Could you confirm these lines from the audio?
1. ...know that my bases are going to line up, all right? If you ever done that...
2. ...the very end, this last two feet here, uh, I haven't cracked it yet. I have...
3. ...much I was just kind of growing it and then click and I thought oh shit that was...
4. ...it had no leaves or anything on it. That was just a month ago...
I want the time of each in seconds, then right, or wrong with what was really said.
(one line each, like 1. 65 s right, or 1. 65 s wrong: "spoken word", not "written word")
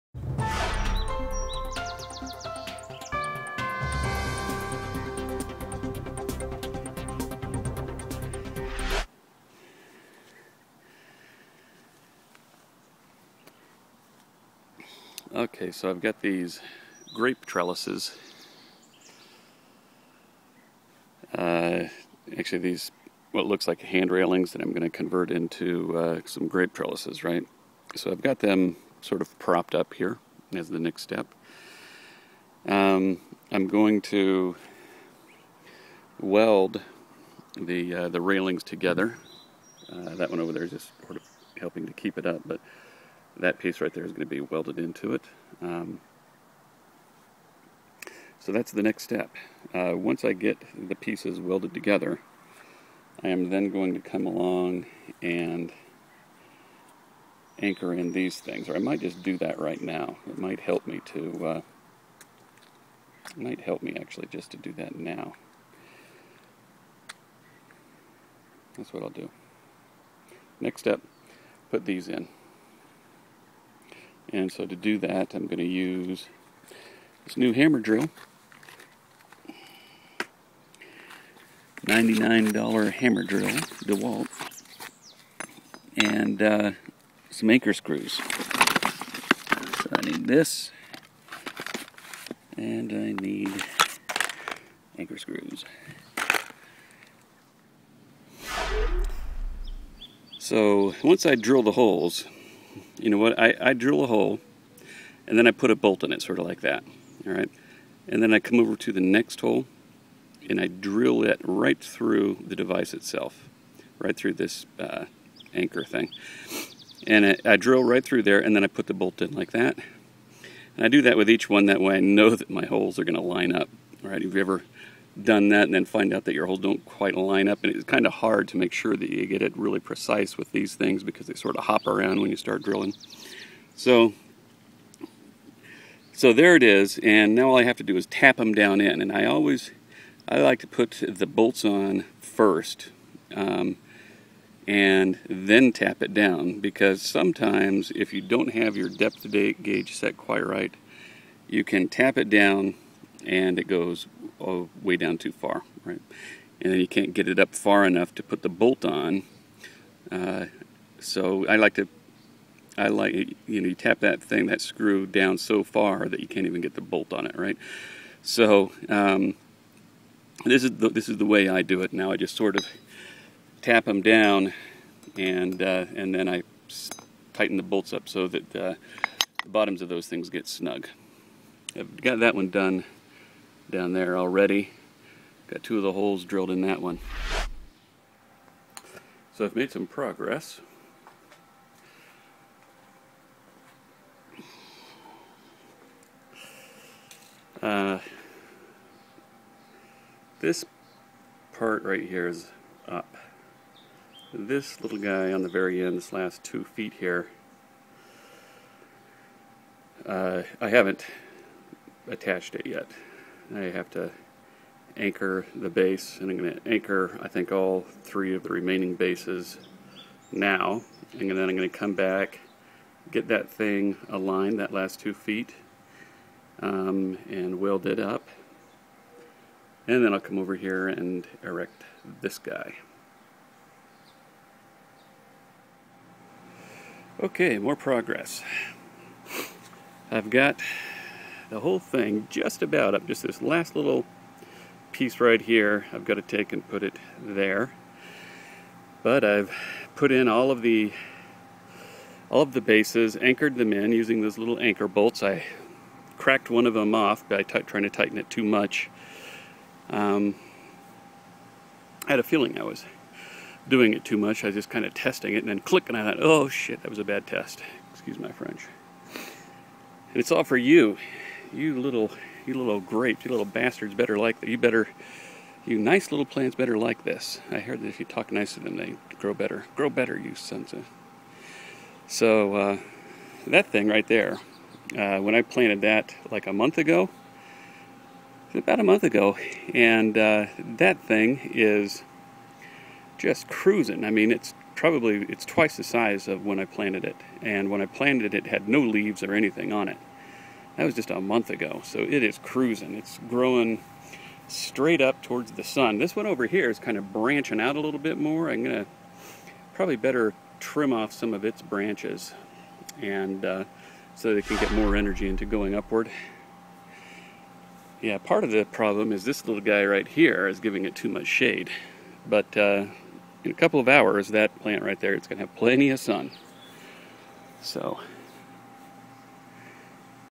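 1. 121 s wrong: "holes", not "bases"
2. 205 s wrong: "attached", not "cracked"
3. 264 s wrong: "testing", not "growing"
4. 298 s right.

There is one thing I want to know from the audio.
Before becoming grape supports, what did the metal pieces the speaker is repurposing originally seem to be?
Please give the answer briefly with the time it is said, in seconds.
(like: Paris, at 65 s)
Hand railings, at 23 s.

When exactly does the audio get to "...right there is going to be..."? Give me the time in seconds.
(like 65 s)
43 s.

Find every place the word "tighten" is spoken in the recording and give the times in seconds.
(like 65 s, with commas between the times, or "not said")
177 s, 257 s.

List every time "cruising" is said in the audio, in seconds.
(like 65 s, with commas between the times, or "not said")
293 s, 302 s.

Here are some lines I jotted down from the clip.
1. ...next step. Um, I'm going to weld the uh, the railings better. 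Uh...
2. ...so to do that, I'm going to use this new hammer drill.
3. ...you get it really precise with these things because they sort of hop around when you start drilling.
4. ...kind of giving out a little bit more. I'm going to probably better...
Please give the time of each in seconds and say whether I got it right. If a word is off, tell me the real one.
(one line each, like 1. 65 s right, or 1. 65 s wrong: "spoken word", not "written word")
1. 30 s wrong: "together", not "better"
2. 74 s right
3. 129 s right
4. 306 s wrong: "branching", not "giving".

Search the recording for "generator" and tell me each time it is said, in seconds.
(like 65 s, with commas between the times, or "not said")
not said.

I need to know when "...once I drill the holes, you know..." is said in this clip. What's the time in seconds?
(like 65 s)
101 s.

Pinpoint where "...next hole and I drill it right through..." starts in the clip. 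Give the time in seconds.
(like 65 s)
109 s.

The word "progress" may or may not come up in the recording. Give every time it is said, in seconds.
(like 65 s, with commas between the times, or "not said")
189 s, 237 s.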